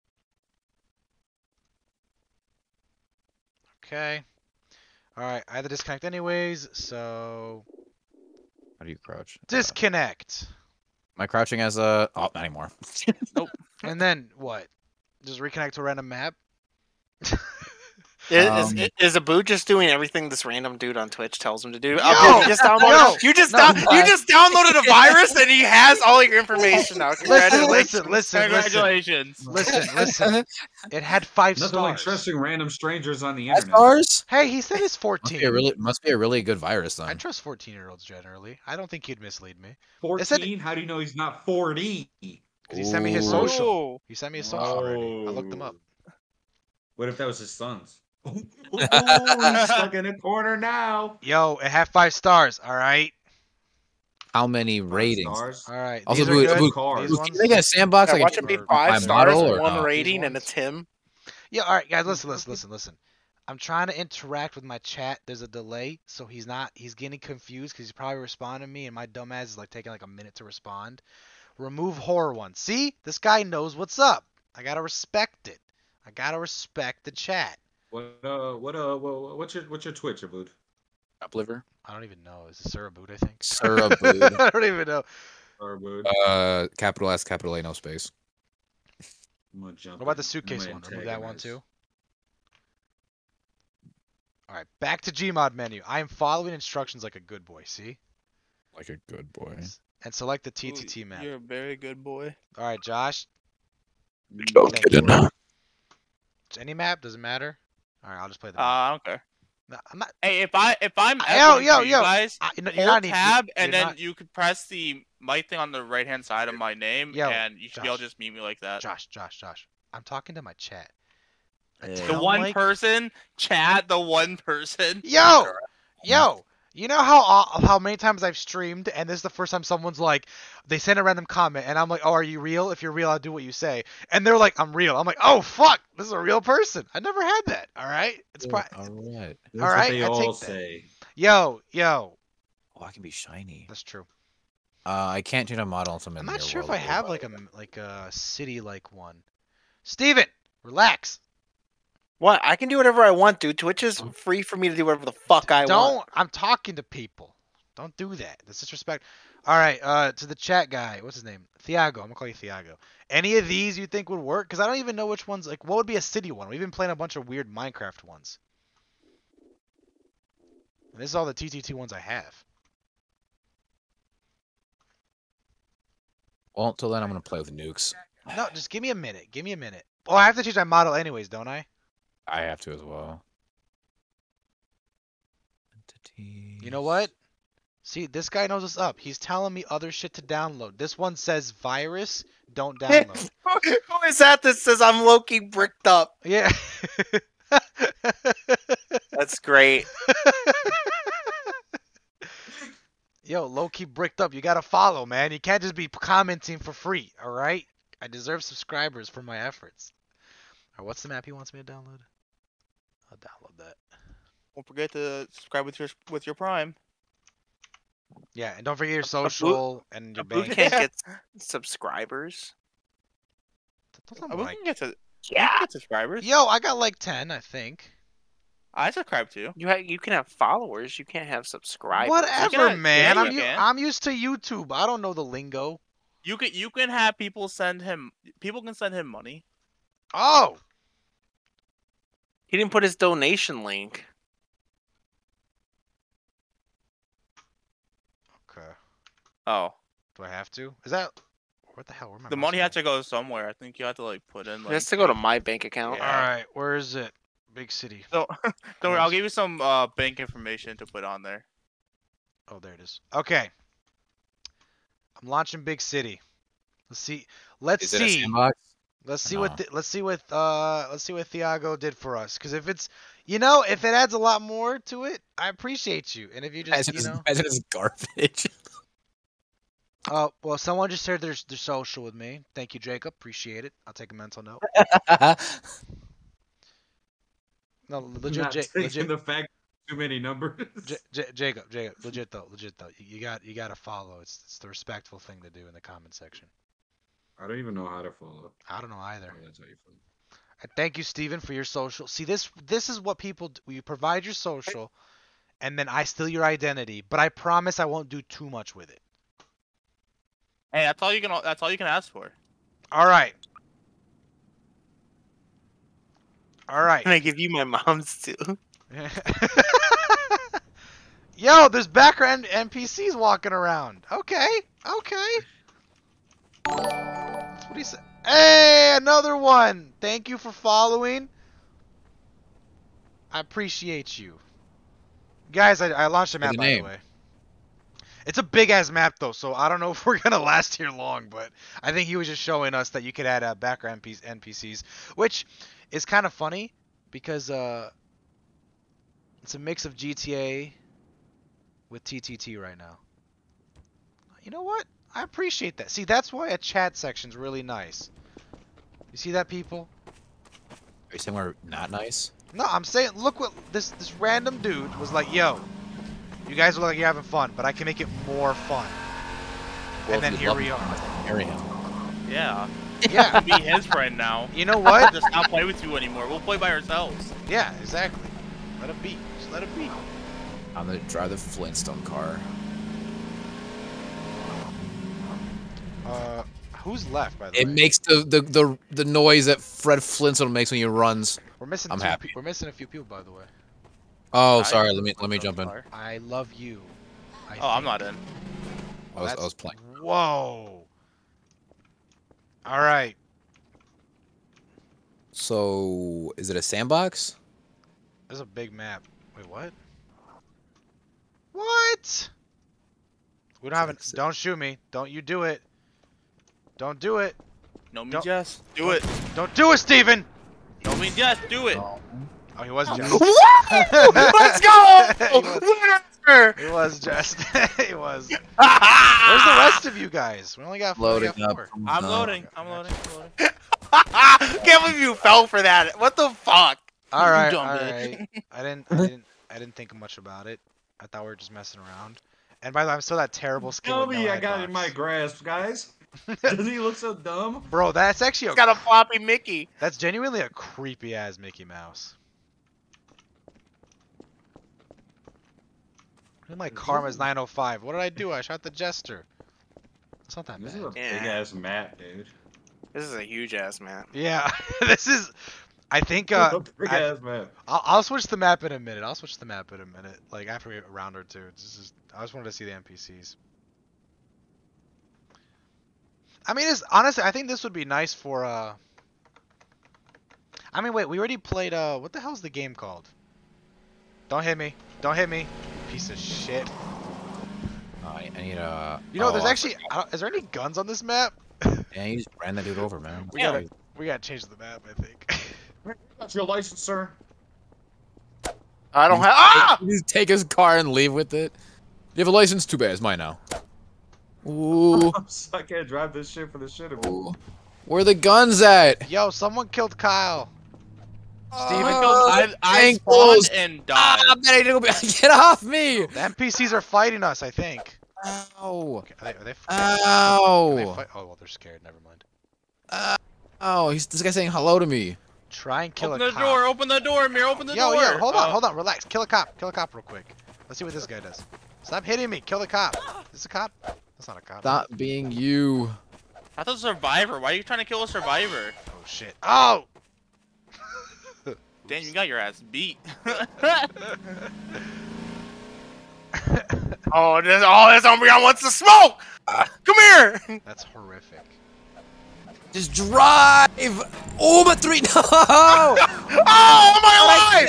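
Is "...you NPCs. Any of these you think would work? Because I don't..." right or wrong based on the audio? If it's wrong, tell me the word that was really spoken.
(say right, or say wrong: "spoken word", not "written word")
wrong: "Thiago", not "NPCs".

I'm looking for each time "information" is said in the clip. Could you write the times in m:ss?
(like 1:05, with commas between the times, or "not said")
0:26, 4:20.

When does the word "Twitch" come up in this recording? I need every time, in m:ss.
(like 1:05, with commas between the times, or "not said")
0:21, 1:19, 2:33.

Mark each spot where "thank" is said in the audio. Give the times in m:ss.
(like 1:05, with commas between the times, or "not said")
4:42, 5:00, 5:30.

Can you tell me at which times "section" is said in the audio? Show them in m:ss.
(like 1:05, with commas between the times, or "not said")
4:56, 5:56.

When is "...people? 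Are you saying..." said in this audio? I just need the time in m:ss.
5:59.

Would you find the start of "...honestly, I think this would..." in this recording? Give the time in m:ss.
7:56.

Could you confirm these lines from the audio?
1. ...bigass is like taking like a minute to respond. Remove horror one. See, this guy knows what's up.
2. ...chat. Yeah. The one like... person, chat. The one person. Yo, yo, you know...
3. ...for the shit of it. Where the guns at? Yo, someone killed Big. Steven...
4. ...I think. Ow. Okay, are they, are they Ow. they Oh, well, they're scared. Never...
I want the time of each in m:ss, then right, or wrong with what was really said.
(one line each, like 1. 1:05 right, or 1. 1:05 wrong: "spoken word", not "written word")
1. 1:09 wrong: "dumbass", not "bigass"
2. 2:00 right
3. 8:26 wrong: "Kyle", not "Big"
4. 8:37 right.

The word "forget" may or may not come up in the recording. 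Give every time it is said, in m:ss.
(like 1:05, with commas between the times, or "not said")
3:34, 3:38.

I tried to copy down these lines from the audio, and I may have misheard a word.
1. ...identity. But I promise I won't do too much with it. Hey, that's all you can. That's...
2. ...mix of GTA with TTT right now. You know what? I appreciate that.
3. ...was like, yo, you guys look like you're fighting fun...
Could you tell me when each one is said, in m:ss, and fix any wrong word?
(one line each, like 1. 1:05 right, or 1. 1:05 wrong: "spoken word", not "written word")
1. 5:06 right
2. 5:49 right
3. 6:04 wrong: "having", not "fighting".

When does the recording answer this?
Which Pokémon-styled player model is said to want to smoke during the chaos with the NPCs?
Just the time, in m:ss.
9:08.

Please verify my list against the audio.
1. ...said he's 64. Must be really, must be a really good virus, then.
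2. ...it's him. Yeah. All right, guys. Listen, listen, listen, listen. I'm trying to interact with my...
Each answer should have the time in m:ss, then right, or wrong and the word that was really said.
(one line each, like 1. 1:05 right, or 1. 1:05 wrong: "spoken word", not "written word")
1. 0:34 wrong: "14", not "64"
2. 1:00 right.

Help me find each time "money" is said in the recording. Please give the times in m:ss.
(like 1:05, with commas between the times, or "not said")
3:59, 4:12.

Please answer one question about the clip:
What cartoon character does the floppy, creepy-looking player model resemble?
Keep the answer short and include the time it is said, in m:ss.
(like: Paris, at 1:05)
Mickey Mouse, at 7:31.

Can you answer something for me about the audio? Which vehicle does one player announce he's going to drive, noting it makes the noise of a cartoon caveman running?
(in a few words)
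the Flintstone car.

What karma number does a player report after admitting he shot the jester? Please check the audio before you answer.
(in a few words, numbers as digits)
905.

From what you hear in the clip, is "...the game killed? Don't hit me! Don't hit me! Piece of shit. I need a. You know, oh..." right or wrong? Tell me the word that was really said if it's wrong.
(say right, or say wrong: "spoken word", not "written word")
wrong: "called", not "killed".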